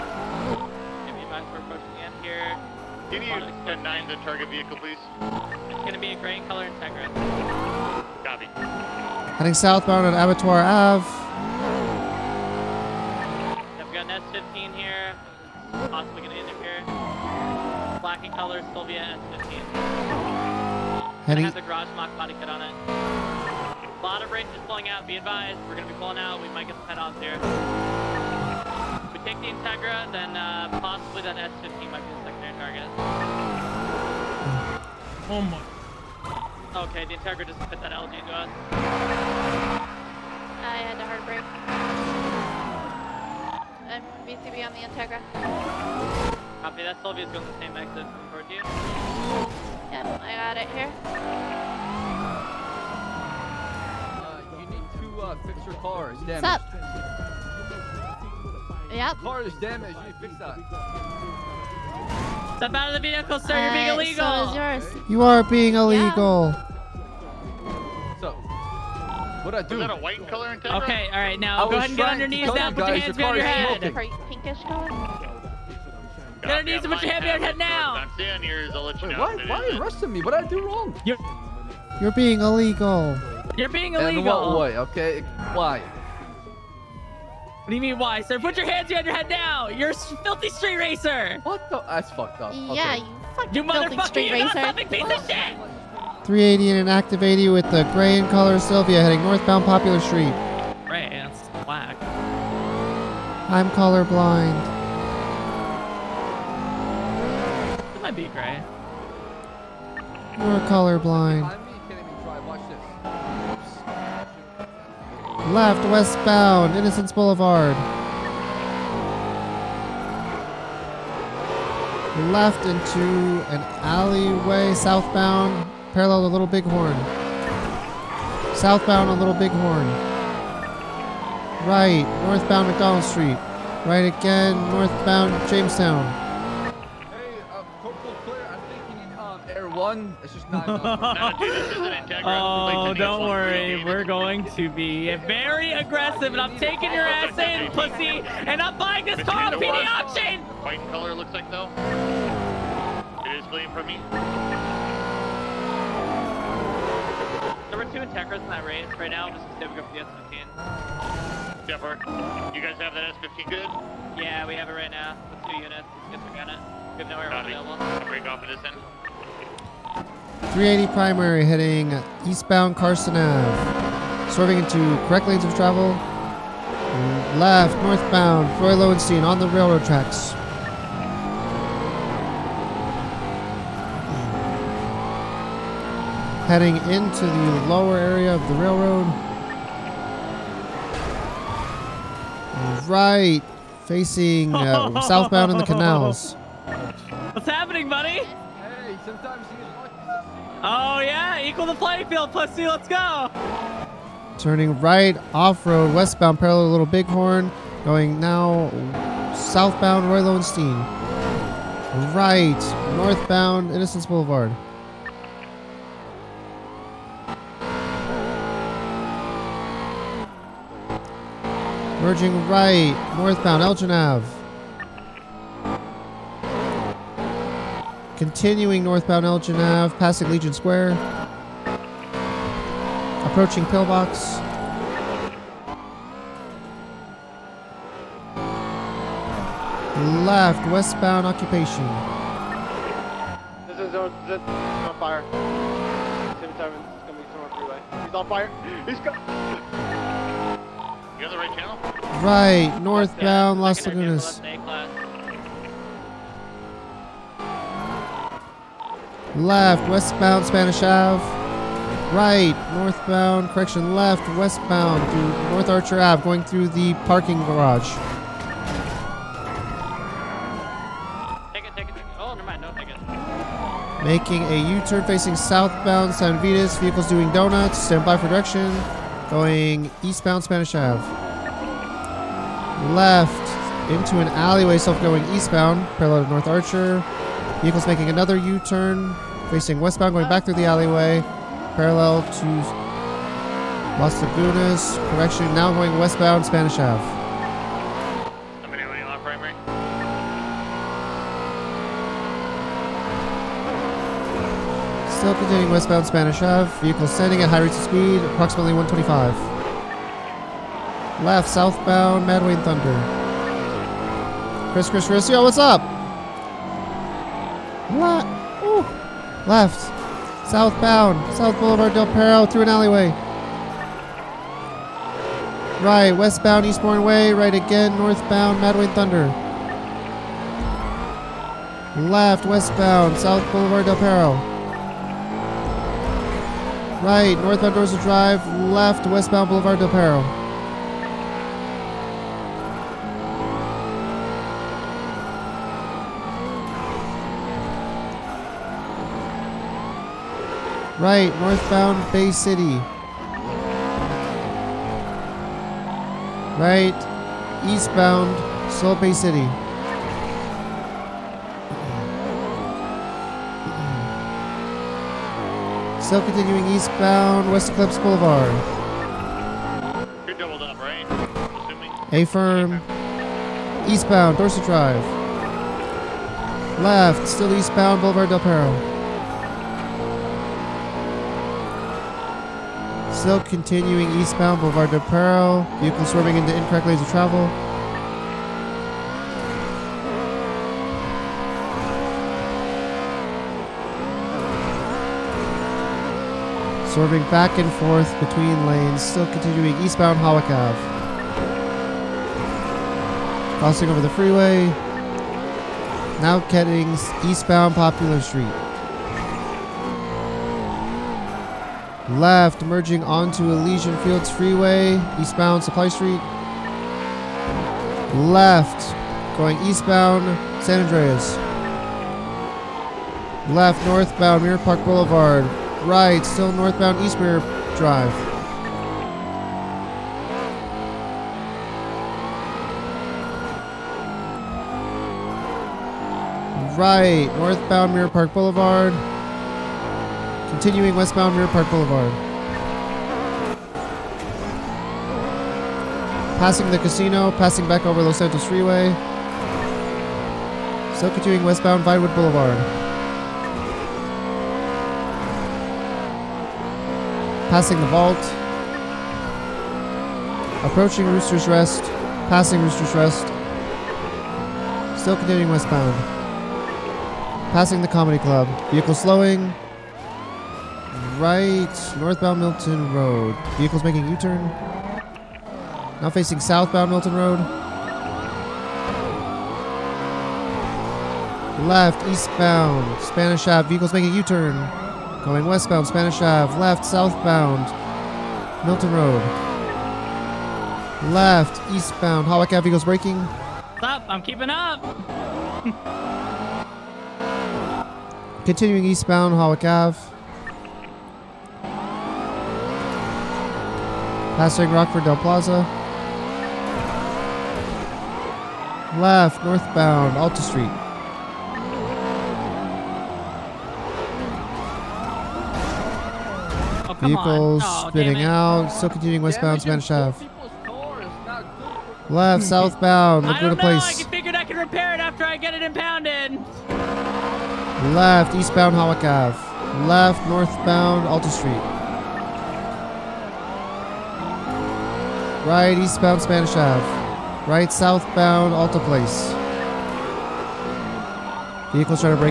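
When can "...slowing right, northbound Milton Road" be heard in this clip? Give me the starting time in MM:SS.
07:48.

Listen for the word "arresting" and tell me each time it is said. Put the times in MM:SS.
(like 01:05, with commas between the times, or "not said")
01:19.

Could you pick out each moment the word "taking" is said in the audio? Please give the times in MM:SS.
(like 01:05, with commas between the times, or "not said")
02:26.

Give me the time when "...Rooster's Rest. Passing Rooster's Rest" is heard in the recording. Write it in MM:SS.
07:41.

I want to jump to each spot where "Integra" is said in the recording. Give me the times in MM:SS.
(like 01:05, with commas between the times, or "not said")
00:06, 00:29, 00:37, 00:46.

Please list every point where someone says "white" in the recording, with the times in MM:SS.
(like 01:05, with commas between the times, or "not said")
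01:10, 02:30.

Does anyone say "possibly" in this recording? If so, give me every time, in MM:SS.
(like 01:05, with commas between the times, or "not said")
00:30.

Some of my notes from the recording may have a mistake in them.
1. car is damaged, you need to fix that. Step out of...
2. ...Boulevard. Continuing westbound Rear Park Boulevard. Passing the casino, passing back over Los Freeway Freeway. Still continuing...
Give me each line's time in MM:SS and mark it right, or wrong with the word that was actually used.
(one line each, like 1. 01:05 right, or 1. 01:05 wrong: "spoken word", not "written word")
1. 00:59 right
2. 07:18 wrong: "Santos", not "Freeway".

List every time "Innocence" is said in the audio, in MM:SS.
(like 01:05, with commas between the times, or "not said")
01:56, 03:33.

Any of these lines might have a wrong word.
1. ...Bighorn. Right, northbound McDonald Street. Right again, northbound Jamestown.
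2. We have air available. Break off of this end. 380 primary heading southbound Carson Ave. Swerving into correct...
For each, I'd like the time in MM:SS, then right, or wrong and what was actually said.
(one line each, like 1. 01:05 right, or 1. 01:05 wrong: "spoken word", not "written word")
1. 02:09 right
2. 02:46 wrong: "eastbound", not "southbound".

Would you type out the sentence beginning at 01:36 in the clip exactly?
380 and an active 80 with the gray in color Silvia heading northbound Popular Street.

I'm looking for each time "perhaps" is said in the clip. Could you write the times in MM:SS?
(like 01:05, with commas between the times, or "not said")
not said.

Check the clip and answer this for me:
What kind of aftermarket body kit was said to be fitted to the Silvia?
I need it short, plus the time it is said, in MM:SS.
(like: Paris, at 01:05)
Garage mock, at 00:21.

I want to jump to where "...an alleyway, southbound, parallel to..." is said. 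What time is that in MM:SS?
02:03.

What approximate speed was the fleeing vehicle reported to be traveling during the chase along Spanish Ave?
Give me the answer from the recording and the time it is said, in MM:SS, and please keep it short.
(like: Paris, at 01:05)
125, at 05:08.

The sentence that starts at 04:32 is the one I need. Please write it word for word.
Oh, mind, no Making a U-turn facing southbound San Vitus.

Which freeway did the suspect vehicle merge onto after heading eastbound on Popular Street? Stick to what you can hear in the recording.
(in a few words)
Elysian Fields Freeway.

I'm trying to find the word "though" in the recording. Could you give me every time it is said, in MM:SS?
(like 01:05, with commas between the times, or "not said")
02:31.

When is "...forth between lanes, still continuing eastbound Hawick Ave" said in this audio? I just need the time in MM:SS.
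06:37.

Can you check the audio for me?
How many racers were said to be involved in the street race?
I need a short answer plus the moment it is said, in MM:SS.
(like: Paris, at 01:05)
2, at 02:37.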